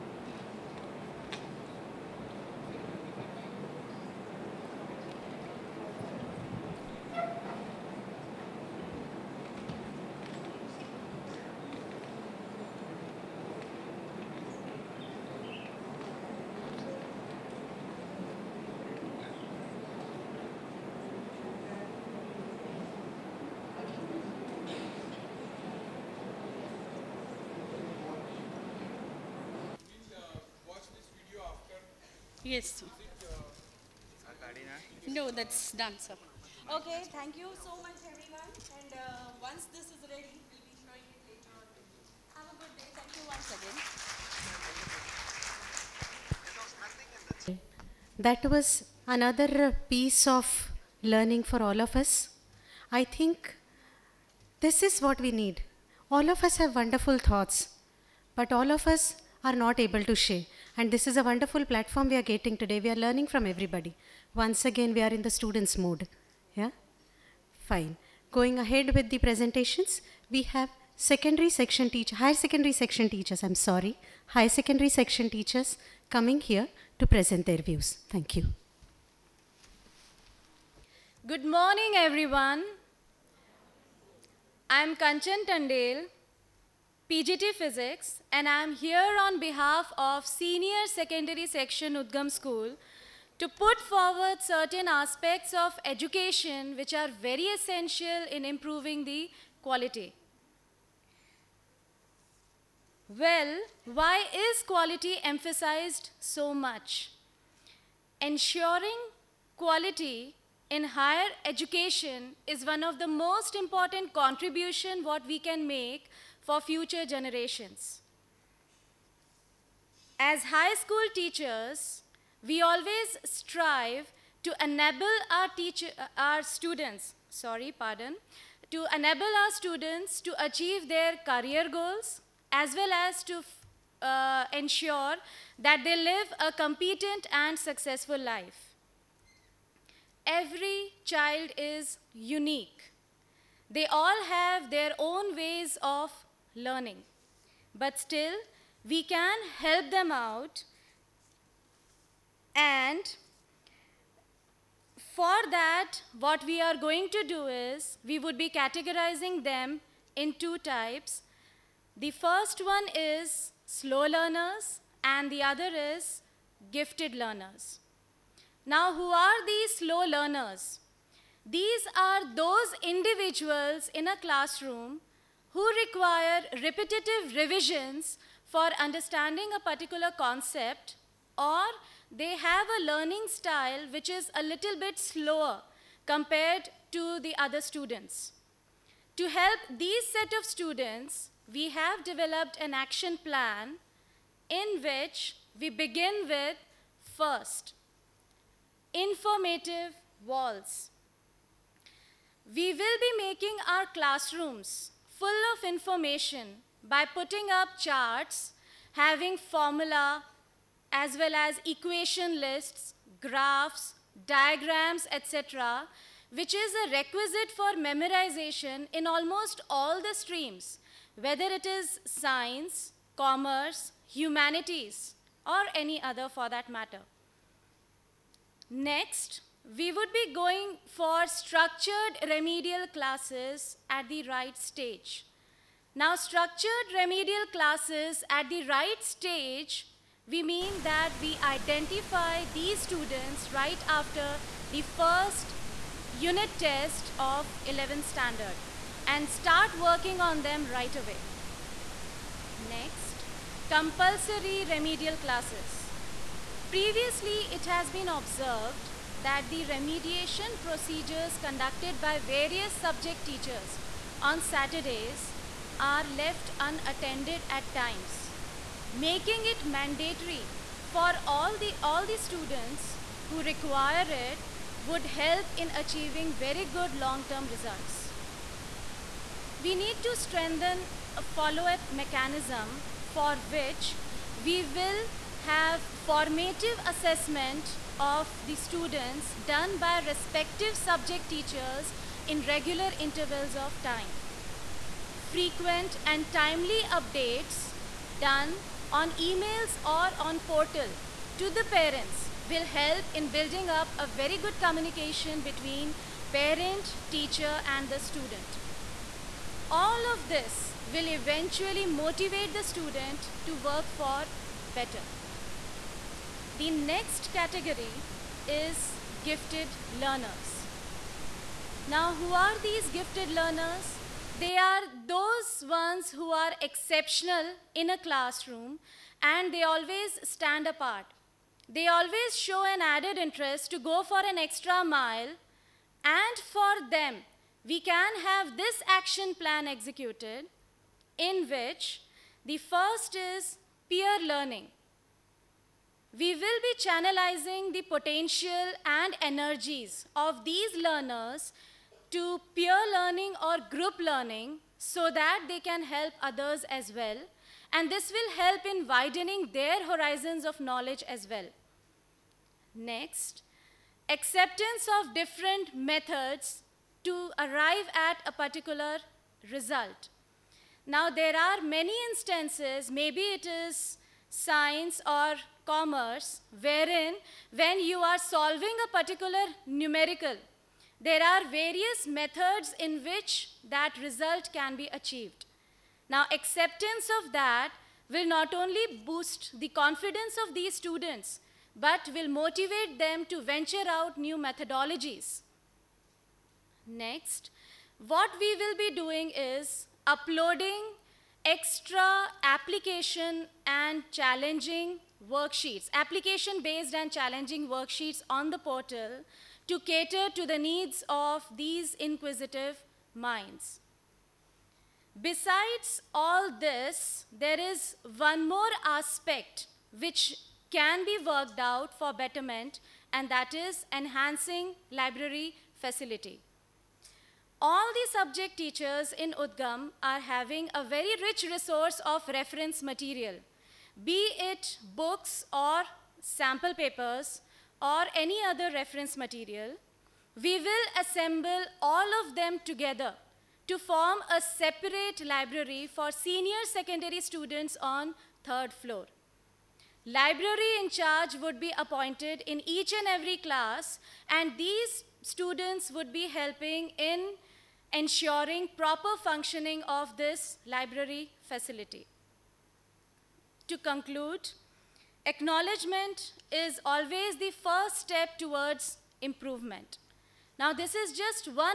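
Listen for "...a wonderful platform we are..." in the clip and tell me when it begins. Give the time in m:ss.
1:01.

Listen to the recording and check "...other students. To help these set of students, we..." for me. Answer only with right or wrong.
right.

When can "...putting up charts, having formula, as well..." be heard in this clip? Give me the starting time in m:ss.
3:27.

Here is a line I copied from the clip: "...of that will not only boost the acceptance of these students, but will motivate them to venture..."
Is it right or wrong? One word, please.
wrong.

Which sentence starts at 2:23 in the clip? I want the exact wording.
They all have their own ways of learning.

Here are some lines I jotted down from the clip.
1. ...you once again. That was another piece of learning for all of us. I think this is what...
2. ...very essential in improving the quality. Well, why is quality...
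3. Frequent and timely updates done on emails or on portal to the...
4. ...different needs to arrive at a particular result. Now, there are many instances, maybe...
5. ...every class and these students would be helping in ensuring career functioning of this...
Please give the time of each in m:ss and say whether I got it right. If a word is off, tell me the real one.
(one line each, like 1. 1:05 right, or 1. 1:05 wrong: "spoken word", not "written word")
1. 0:43 right
2. 1:37 right
3. 4:55 right
4. 6:05 wrong: "methods", not "needs"
5. 7:33 wrong: "proper", not "career".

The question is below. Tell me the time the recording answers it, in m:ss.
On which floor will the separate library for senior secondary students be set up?
7:28.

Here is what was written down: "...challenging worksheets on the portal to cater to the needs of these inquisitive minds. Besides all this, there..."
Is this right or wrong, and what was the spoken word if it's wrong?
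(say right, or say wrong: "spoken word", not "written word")
right.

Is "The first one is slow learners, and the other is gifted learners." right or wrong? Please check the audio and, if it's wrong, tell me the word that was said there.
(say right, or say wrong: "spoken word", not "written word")
right.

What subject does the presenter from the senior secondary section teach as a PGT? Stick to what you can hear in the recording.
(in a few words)
Physics.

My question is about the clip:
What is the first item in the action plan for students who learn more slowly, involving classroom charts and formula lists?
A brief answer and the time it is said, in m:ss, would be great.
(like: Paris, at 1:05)
Informative walls, at 3:18.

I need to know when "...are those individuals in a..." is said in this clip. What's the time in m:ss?
2:51.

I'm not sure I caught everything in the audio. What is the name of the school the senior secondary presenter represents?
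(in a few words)
Udgam School.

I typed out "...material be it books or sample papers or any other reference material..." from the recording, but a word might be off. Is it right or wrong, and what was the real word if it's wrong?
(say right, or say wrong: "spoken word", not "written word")
right.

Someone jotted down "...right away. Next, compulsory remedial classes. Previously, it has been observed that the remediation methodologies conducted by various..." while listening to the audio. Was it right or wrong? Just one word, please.
wrong.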